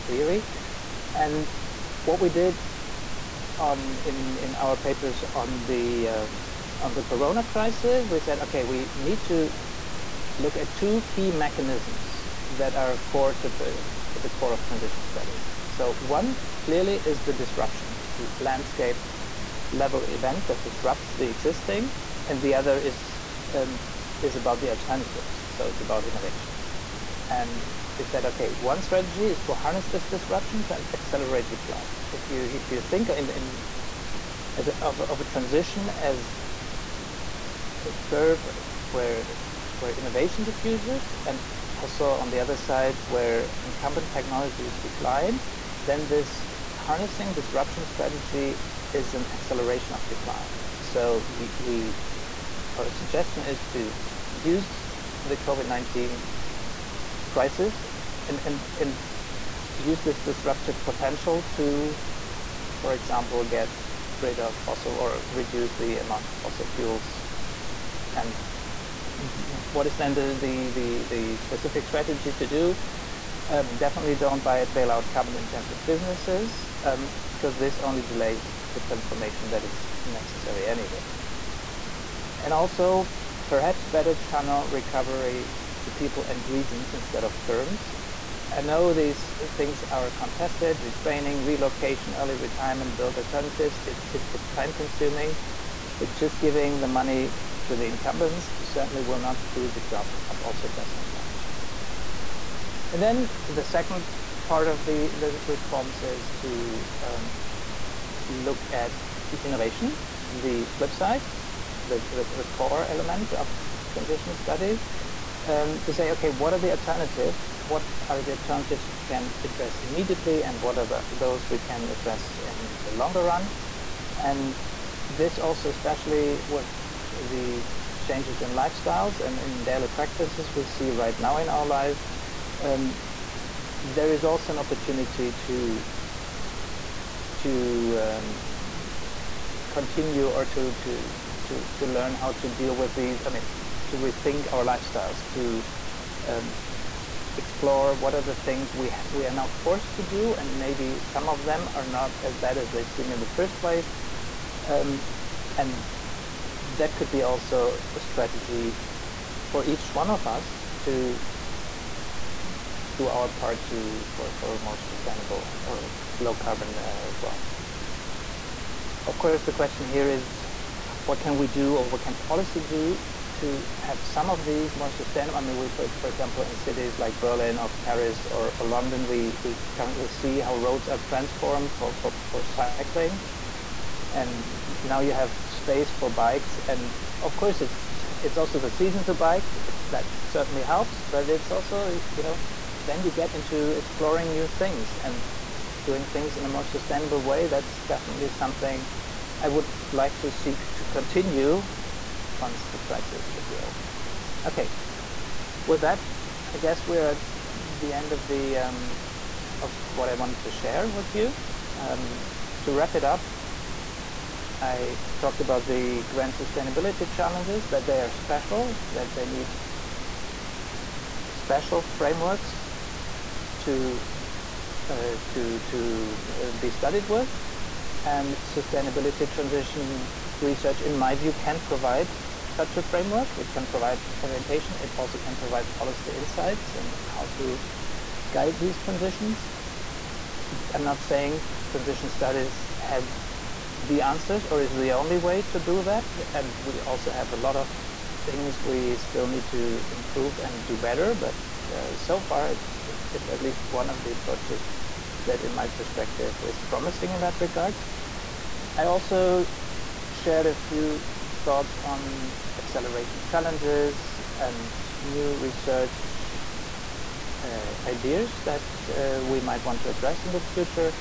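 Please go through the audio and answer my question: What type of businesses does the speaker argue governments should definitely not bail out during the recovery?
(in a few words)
Carbon intensive businesses.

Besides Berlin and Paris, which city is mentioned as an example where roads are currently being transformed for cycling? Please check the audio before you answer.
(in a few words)
London.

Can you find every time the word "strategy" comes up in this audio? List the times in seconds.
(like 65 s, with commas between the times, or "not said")
28 s, 47 s, 71 s, 157 s.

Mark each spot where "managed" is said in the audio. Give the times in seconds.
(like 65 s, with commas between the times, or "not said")
not said.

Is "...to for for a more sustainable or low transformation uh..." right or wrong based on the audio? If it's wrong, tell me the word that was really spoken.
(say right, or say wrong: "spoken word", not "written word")
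wrong: "carbon", not "transformation".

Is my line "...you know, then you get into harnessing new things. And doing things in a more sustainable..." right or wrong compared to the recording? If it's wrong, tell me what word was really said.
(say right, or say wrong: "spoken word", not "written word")
wrong: "exploring", not "harnessing".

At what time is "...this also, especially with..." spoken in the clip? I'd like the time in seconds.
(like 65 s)
125 s.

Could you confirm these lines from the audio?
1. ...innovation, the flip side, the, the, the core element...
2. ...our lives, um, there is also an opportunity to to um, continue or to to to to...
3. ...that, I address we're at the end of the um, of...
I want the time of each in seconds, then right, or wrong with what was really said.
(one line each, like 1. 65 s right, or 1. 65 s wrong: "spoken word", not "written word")
1. 109 s right
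2. 131 s right
3. 205 s wrong: "guess", not "address".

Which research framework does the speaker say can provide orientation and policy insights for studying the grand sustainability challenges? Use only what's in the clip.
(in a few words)
Sustainability transition research.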